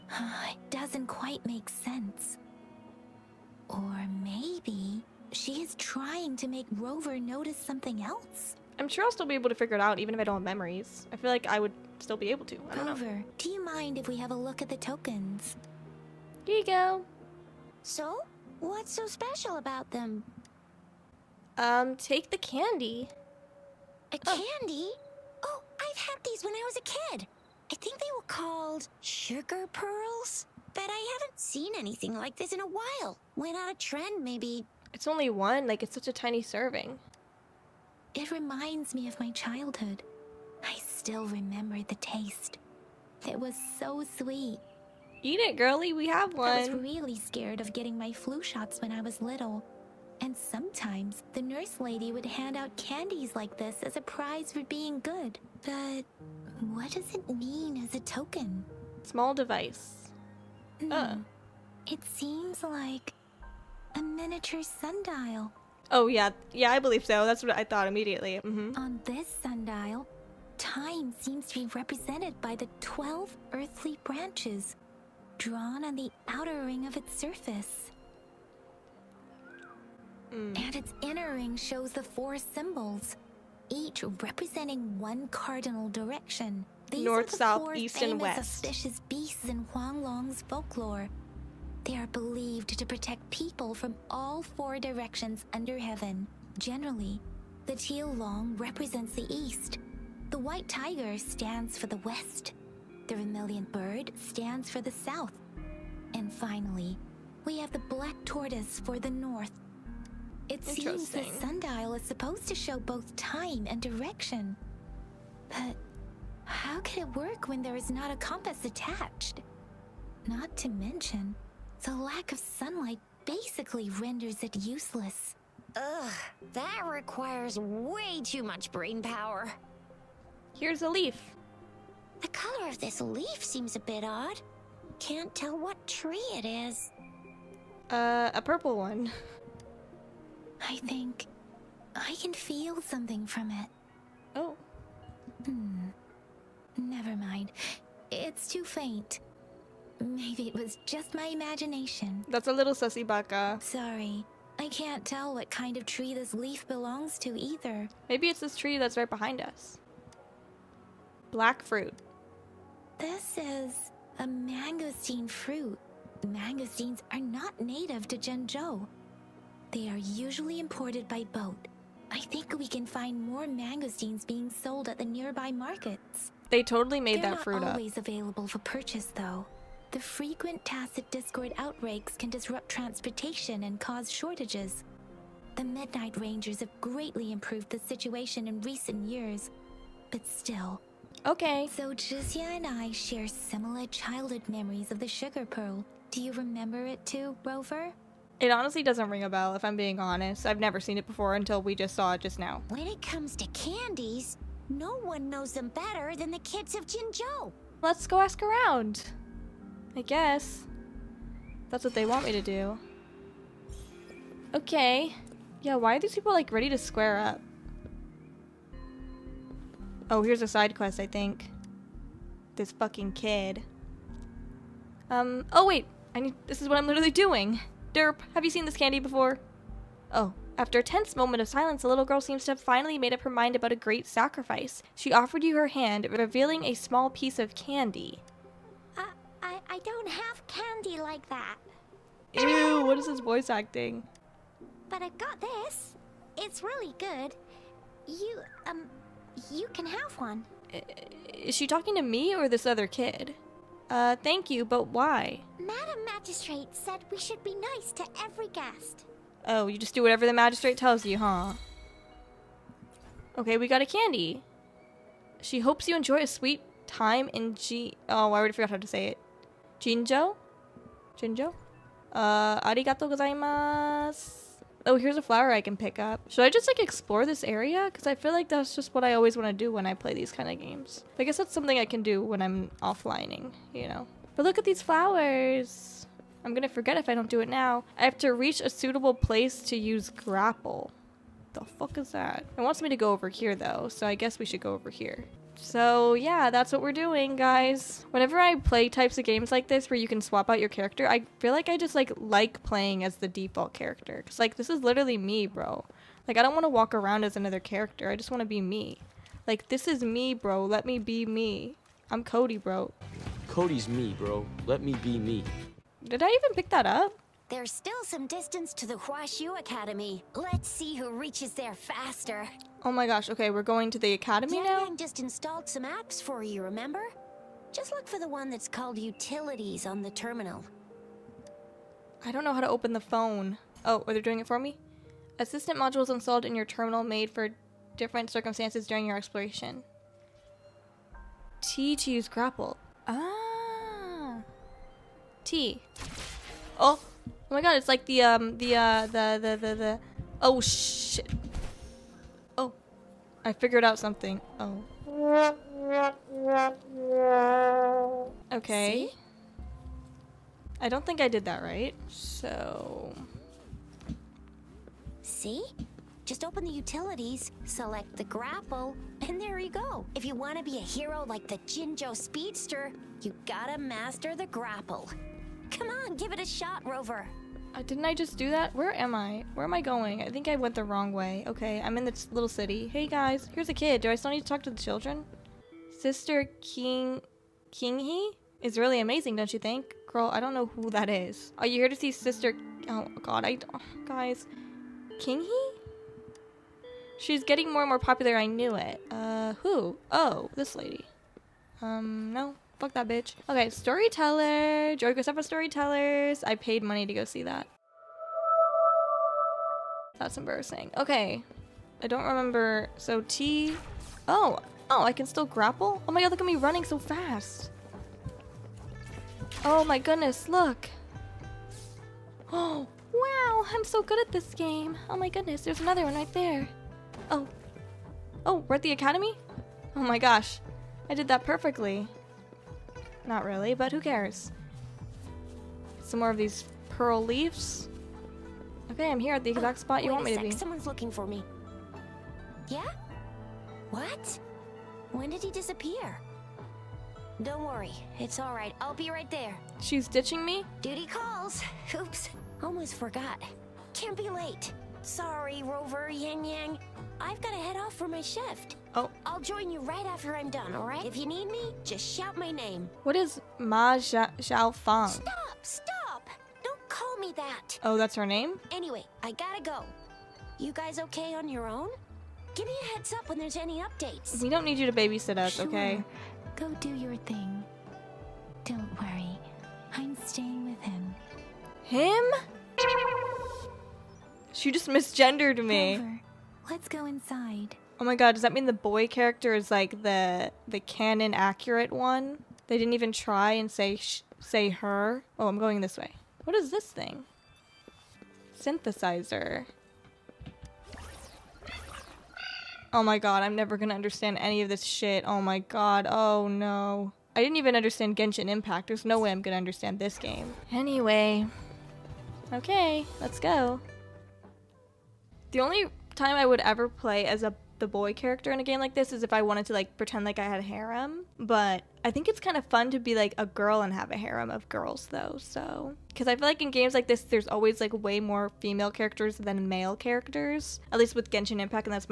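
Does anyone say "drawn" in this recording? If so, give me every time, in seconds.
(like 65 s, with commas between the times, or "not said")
75 s.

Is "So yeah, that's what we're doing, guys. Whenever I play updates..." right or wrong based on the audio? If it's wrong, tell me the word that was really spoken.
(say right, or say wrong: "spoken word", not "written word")
wrong: "types", not "updates".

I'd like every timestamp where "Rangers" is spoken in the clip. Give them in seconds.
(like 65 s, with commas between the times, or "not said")
186 s.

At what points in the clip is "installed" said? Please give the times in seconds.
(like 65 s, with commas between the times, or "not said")
325 s, 336 s.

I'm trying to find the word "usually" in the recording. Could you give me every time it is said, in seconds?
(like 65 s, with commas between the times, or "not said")
169 s.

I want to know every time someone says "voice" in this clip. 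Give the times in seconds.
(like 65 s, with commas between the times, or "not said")
243 s.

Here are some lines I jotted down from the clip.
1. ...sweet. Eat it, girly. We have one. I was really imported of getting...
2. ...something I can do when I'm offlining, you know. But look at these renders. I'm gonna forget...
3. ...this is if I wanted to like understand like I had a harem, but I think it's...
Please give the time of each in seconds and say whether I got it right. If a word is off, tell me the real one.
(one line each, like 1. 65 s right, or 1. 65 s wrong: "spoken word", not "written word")
1. 44 s wrong: "scared", not "imported"
2. 281 s wrong: "flowers", not "renders"
3. 518 s wrong: "pretend", not "understand".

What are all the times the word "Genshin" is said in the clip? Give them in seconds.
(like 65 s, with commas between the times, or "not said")
508 s, 531 s.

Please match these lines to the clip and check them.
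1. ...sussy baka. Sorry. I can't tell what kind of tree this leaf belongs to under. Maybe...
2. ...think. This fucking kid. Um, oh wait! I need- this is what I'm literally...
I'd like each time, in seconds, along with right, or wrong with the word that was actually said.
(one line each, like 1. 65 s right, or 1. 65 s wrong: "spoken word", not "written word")
1. 152 s wrong: "either", not "under"
2. 221 s right.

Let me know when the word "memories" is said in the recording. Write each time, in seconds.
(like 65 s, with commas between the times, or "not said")
10 s, 194 s.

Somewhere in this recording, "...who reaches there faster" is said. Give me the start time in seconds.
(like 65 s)
320 s.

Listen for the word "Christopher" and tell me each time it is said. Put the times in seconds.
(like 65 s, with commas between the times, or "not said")
405 s.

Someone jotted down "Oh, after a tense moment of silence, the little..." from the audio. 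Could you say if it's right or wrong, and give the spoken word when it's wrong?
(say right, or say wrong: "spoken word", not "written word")
right.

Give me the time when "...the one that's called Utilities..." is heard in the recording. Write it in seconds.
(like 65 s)
328 s.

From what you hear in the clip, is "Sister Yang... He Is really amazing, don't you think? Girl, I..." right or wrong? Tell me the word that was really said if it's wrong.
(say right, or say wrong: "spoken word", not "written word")
wrong: "King", not "Yang".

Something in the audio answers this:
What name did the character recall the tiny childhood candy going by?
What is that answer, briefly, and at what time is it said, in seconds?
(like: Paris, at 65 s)
Sugar pearls, at 29 s.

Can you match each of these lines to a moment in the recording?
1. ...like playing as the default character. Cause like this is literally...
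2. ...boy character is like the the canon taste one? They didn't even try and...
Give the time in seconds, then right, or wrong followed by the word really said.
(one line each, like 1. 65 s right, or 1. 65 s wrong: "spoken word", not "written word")
1. 302 s right
2. 488 s wrong: "accurate", not "taste".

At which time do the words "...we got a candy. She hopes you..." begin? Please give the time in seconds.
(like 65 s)
263 s.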